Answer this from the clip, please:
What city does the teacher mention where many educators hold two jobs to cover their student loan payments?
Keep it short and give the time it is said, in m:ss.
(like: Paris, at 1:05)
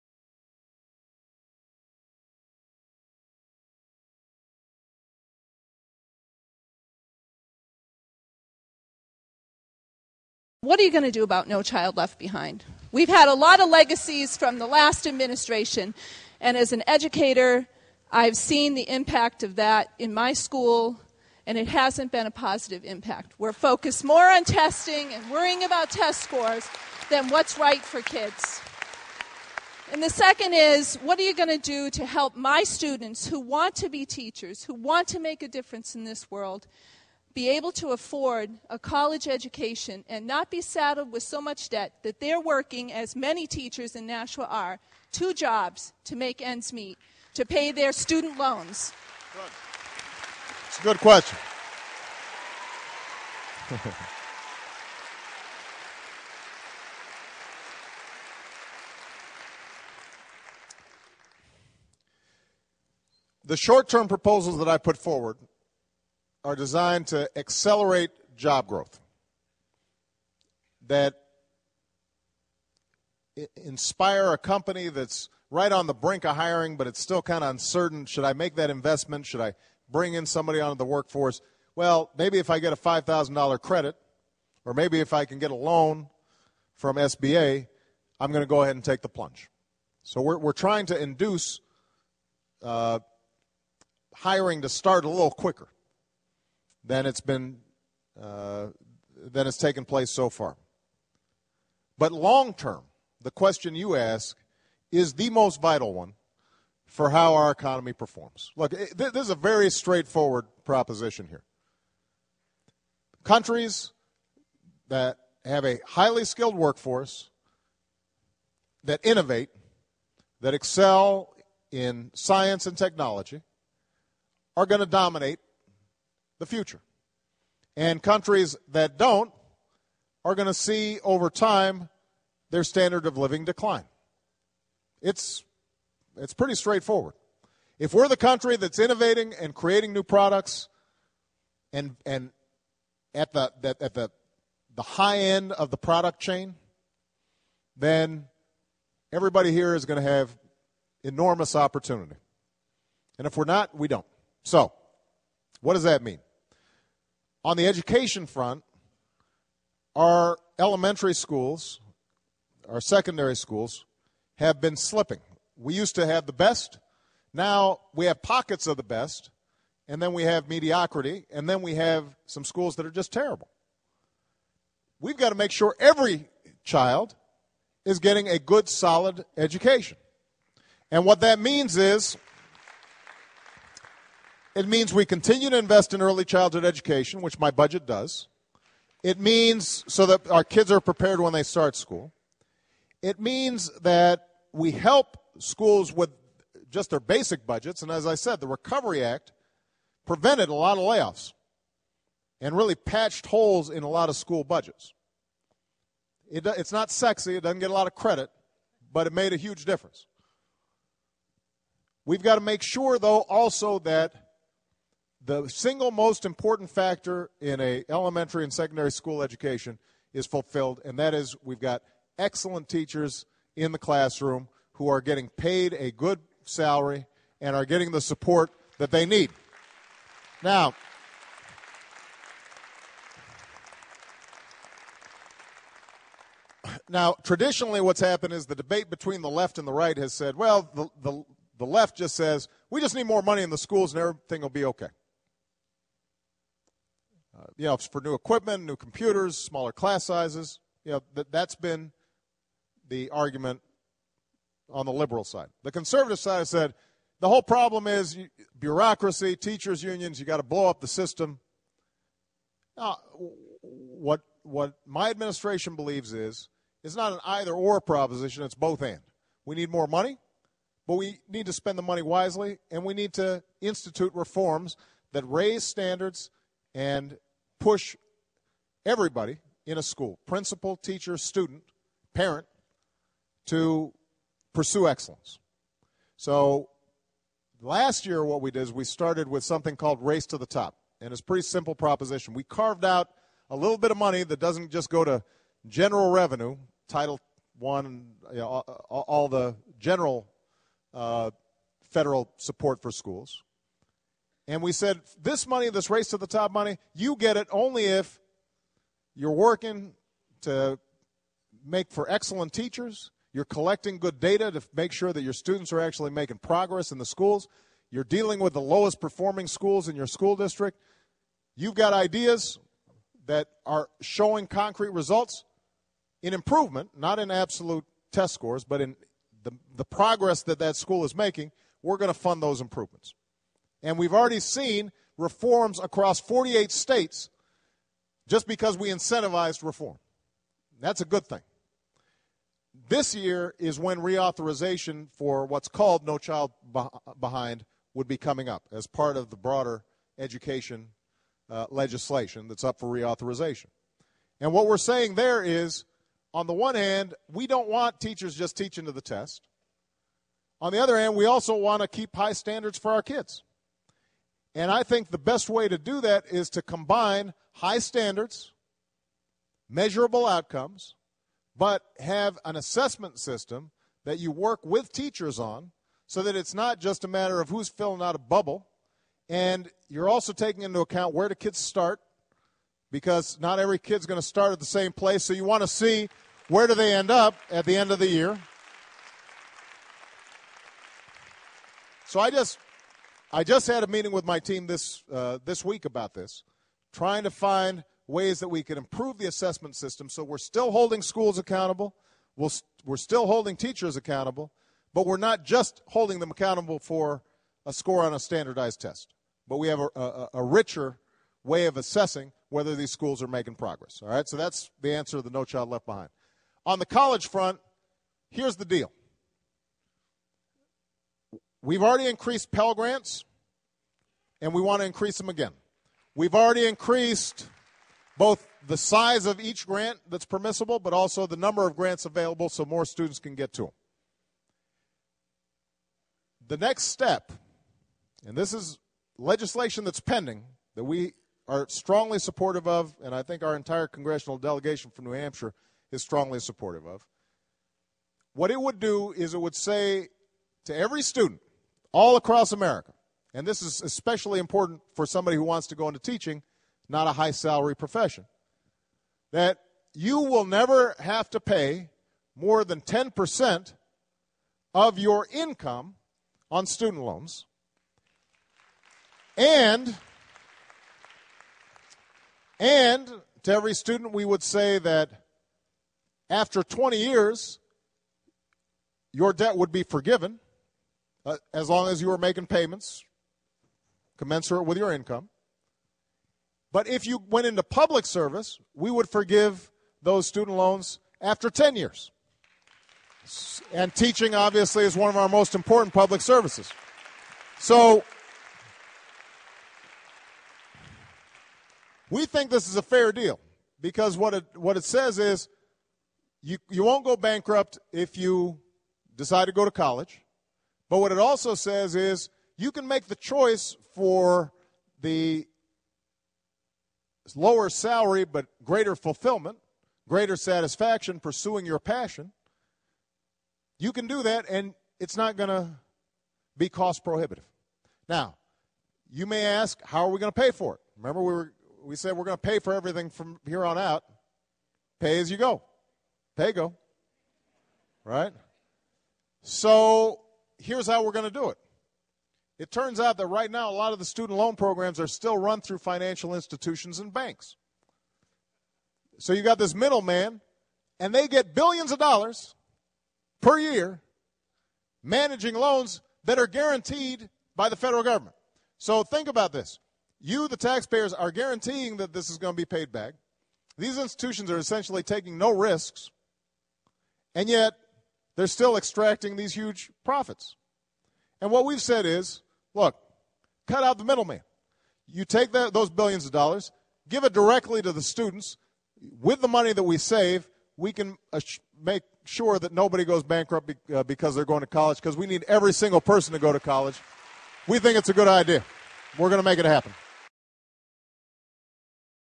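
Nashua, at 0:44.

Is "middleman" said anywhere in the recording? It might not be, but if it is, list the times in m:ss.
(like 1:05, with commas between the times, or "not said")
9:09, 9:34.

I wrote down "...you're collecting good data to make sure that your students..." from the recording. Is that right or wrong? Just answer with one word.
right.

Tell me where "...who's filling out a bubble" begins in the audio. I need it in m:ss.
6:17.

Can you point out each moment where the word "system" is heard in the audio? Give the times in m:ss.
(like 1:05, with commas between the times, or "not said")
4:20, 6:13, 6:39.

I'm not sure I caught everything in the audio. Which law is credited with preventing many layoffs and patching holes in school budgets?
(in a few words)
Recovery Act.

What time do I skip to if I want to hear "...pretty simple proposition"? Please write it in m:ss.
4:51.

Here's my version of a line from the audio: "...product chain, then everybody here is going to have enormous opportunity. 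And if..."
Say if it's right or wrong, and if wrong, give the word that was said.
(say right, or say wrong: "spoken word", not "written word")
right.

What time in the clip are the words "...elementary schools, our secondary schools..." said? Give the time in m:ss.
2:40.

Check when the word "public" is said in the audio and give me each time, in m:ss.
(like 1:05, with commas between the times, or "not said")
8:07, 8:15.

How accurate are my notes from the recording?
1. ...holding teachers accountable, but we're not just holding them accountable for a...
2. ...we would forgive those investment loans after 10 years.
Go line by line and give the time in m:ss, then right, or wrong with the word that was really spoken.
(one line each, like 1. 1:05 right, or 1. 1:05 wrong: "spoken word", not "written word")
1. 6:43 right
2. 8:08 wrong: "student", not "investment".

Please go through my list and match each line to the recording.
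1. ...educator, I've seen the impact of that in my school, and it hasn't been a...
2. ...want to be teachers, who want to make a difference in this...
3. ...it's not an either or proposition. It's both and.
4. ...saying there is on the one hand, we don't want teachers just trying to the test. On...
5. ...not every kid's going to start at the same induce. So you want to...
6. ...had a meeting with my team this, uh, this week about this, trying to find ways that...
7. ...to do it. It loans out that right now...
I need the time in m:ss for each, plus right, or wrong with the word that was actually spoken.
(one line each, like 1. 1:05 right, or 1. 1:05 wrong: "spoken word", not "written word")
1. 0:16 right
2. 0:33 right
3. 4:26 right
4. 5:54 wrong: "teaching", not "trying"
5. 6:23 wrong: "place", not "induce"
6. 6:33 right
7. 9:01 wrong: "turns", not "loans".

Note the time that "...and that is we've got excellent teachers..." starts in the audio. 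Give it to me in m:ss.
3:40.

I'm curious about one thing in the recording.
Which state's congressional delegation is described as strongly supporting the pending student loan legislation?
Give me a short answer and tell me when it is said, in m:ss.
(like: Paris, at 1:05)
New Hampshire, at 7:25.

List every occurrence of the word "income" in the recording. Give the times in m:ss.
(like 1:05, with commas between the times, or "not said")
7:45, 8:04.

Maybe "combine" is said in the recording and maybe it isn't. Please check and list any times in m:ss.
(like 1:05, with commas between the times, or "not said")
6:06.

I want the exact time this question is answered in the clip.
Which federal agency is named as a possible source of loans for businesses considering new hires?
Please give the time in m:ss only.
1:26.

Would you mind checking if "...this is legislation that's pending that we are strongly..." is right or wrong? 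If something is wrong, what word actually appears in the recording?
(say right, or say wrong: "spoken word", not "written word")
right.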